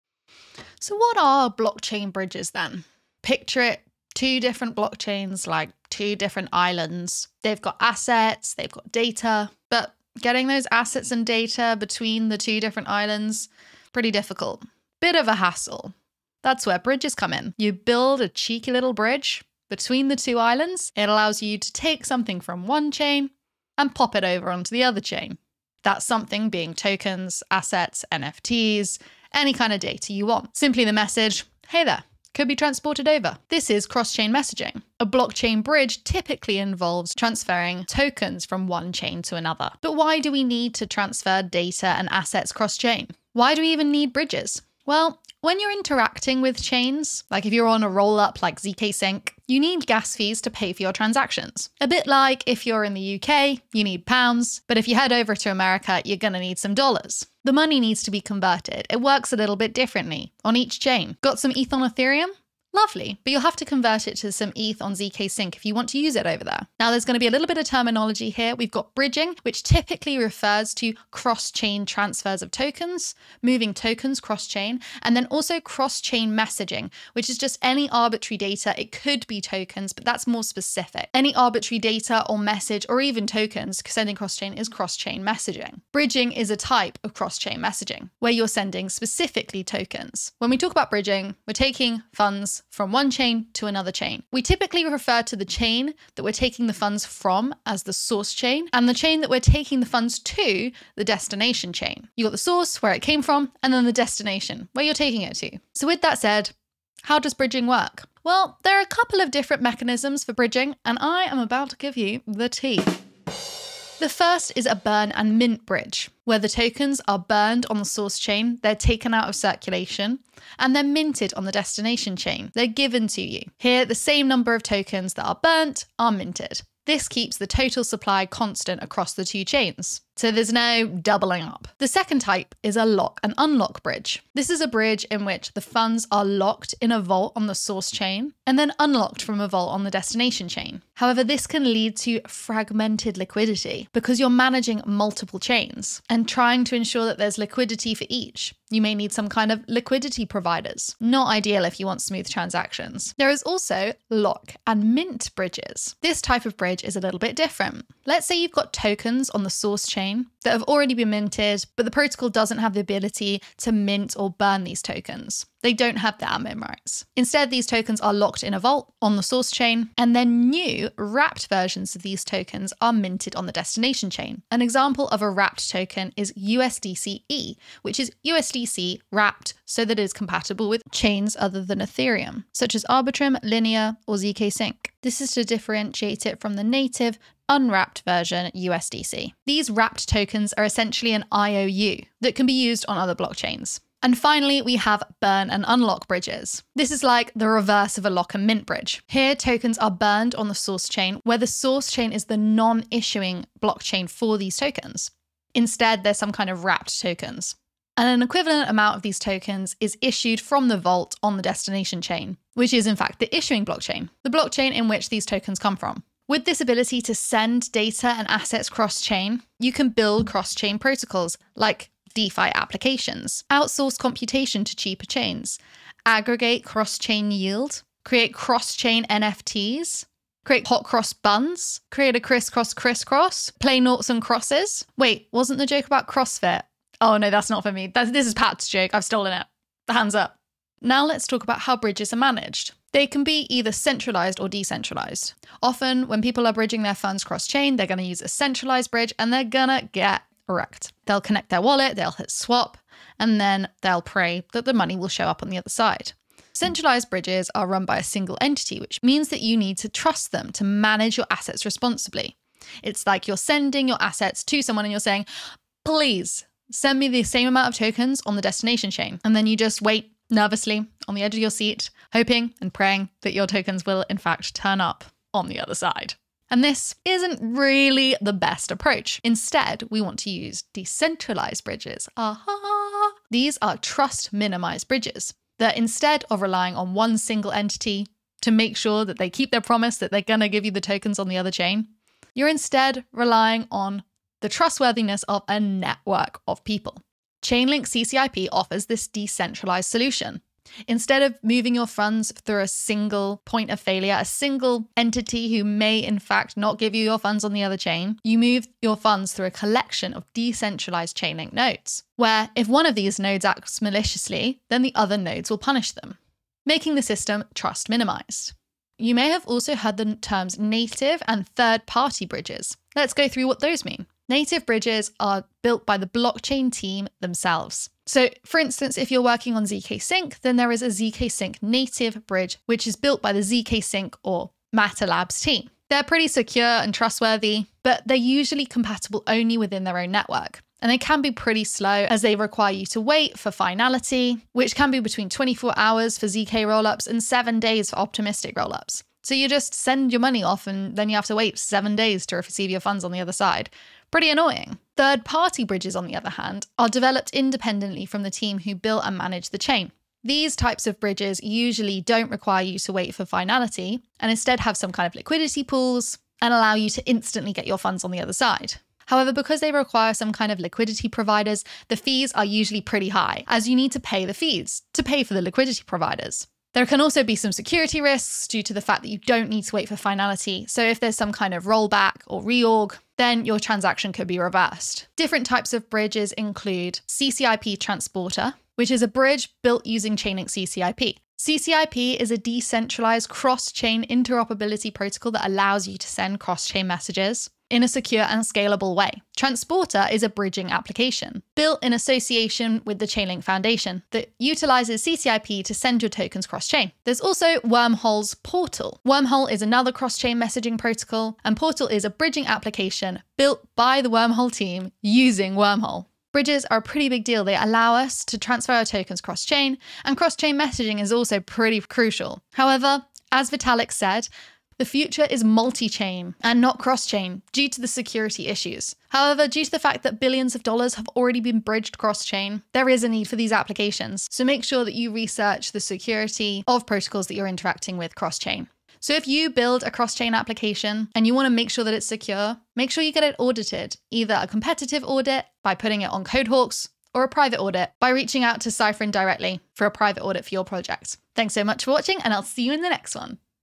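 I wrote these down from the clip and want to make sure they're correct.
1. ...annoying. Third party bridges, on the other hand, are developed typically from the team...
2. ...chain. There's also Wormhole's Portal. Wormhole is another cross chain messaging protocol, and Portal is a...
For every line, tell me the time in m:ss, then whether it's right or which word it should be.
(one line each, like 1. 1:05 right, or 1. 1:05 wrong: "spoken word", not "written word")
1. 5:54 wrong: "independently", not "typically"
2. 6:46 right.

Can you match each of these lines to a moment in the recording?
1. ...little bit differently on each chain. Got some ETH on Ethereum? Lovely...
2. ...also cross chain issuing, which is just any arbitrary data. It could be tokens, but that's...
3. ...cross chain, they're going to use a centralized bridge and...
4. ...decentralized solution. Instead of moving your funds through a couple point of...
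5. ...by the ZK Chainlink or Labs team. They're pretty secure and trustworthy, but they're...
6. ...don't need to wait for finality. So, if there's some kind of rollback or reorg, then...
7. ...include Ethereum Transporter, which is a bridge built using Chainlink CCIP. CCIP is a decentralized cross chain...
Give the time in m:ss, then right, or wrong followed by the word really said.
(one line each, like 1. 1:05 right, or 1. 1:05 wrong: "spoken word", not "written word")
1. 0:59 right
2. 1:15 wrong: "messaging", not "issuing"
3. 4:07 right
4. 4:59 wrong: "single", not "couple"
5. 5:33 wrong: "Sync", not "Chainlink"
6. 6:19 right
7. 6:26 wrong: "CCIP", not "Ethereum".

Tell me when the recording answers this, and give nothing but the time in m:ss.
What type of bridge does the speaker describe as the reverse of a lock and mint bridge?
3:15.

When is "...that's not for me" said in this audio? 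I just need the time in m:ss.
3:57.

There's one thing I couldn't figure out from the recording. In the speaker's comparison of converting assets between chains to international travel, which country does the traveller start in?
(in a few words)
UK.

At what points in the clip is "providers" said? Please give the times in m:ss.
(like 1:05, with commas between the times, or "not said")
2:30, 6:11, 6:15.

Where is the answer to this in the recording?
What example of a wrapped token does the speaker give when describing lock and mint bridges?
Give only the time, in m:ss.
2:56.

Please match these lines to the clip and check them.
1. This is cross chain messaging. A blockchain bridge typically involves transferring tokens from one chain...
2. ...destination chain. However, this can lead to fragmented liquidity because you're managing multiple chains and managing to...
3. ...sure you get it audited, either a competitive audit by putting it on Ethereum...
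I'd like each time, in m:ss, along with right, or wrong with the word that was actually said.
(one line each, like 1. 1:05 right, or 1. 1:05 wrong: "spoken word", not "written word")
1. 0:33 right
2. 2:19 wrong: "trying", not "managing"
3. 7:22 wrong: "Codehawks", not "Ethereum".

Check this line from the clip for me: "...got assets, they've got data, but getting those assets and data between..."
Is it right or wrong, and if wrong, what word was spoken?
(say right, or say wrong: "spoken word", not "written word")
right.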